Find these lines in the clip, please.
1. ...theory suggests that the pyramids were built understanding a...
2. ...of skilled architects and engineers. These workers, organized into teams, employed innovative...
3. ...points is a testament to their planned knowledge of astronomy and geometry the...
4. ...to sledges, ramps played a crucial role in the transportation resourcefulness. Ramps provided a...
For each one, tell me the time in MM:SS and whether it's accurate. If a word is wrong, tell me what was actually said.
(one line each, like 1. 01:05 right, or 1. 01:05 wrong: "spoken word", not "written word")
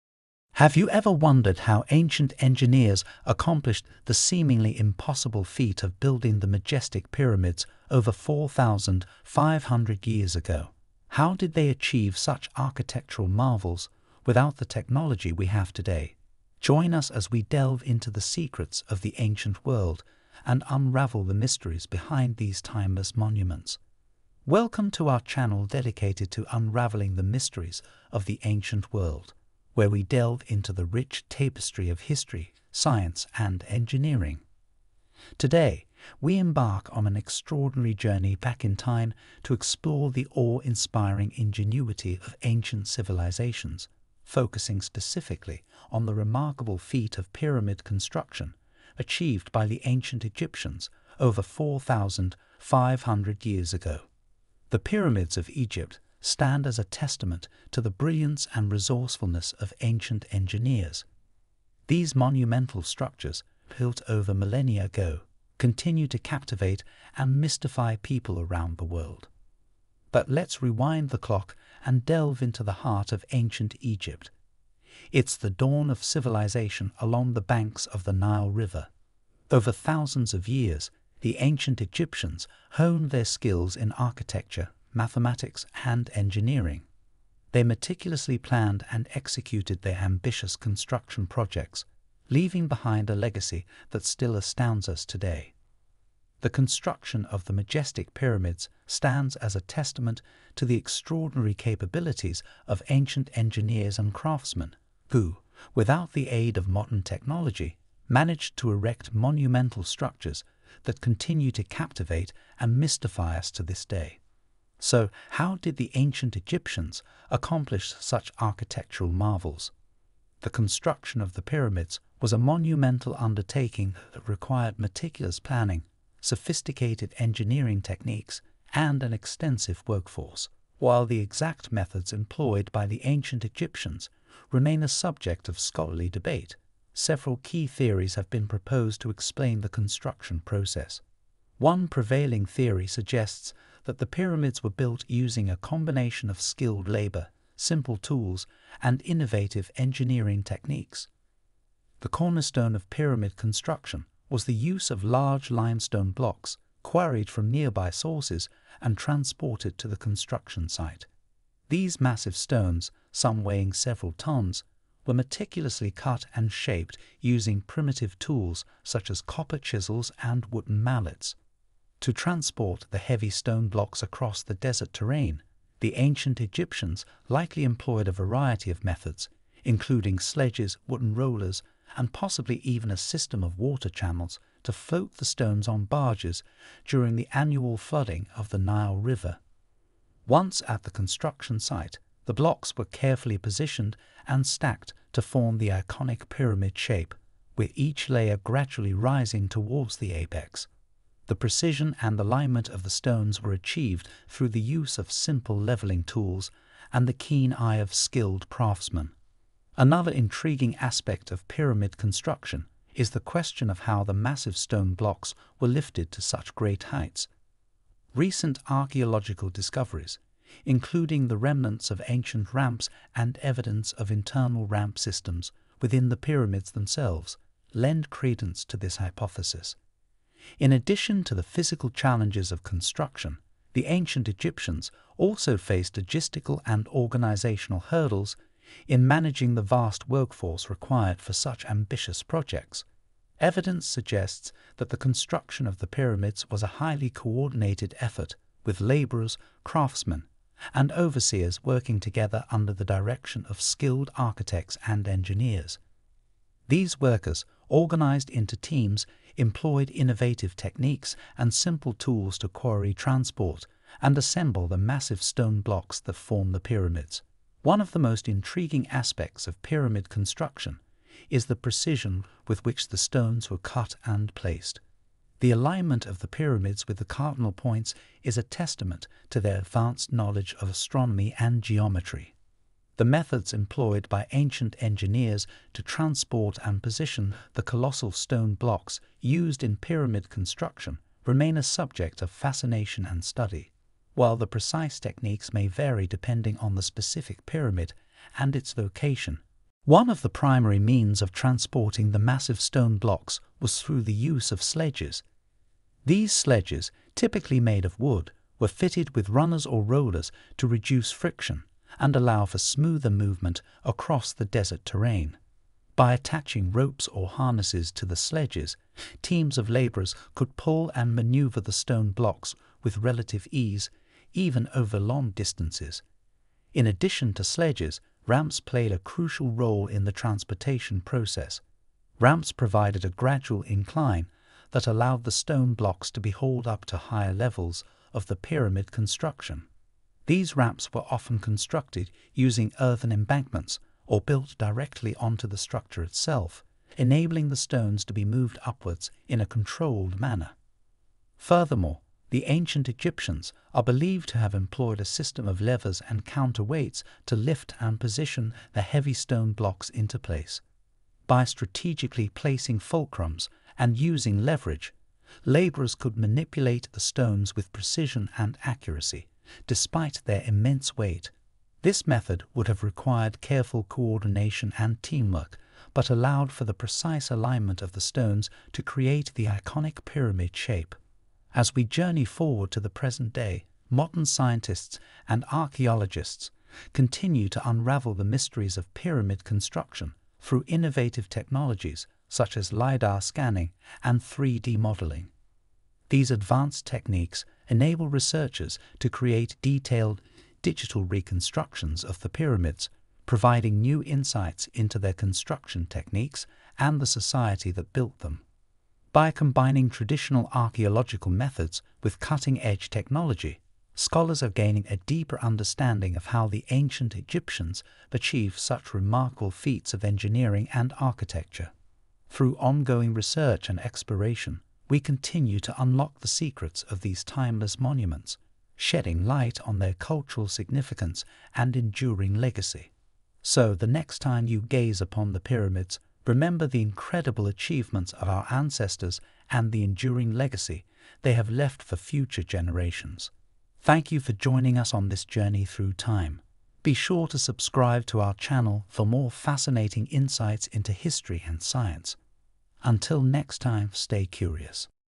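1. 02:22 wrong: "using", not "understanding"
2. 04:13 right
3. 04:37 wrong: "advanced", not "planned"
4. 05:27 wrong: "process", not "resourcefulness".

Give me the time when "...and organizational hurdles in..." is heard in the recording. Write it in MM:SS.
03:56.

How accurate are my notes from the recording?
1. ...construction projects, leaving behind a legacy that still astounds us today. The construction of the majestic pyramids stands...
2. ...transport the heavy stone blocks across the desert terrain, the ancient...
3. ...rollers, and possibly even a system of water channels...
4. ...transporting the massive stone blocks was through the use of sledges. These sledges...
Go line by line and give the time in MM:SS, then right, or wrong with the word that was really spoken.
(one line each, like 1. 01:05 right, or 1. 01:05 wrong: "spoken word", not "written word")
1. 01:30 right
2. 02:52 right
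3. 03:01 right
4. 05:01 right.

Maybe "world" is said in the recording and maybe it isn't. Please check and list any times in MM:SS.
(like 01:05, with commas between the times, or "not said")
00:19, 00:28, 01:08.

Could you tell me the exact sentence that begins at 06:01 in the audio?
By strategically placing fulcrums and using leverage, laborers could manipulate the stones with precision and accuracy, despite their immense weight.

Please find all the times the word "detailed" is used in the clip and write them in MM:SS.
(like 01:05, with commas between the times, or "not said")
06:39.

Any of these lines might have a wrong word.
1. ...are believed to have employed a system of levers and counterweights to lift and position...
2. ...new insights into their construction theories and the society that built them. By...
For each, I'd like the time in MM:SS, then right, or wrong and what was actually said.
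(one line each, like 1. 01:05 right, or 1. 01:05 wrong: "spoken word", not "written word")
1. 05:53 right
2. 06:43 wrong: "techniques", not "theories".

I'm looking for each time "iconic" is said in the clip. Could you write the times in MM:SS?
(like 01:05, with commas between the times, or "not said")
03:15, 06:19.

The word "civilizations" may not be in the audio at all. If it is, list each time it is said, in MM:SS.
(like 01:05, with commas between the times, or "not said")
00:42, 01:16.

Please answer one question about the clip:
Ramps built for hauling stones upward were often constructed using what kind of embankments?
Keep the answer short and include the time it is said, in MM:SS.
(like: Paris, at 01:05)
earthen embankments, at 05:42.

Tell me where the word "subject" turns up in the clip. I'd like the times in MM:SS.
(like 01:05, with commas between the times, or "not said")
02:14, 04:51.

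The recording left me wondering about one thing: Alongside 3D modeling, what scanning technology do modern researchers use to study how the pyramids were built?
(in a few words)
LIDAR.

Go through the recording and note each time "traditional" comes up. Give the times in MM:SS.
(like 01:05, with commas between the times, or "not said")
06:49.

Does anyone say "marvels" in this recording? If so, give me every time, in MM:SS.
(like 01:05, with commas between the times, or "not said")
00:13, 01:59.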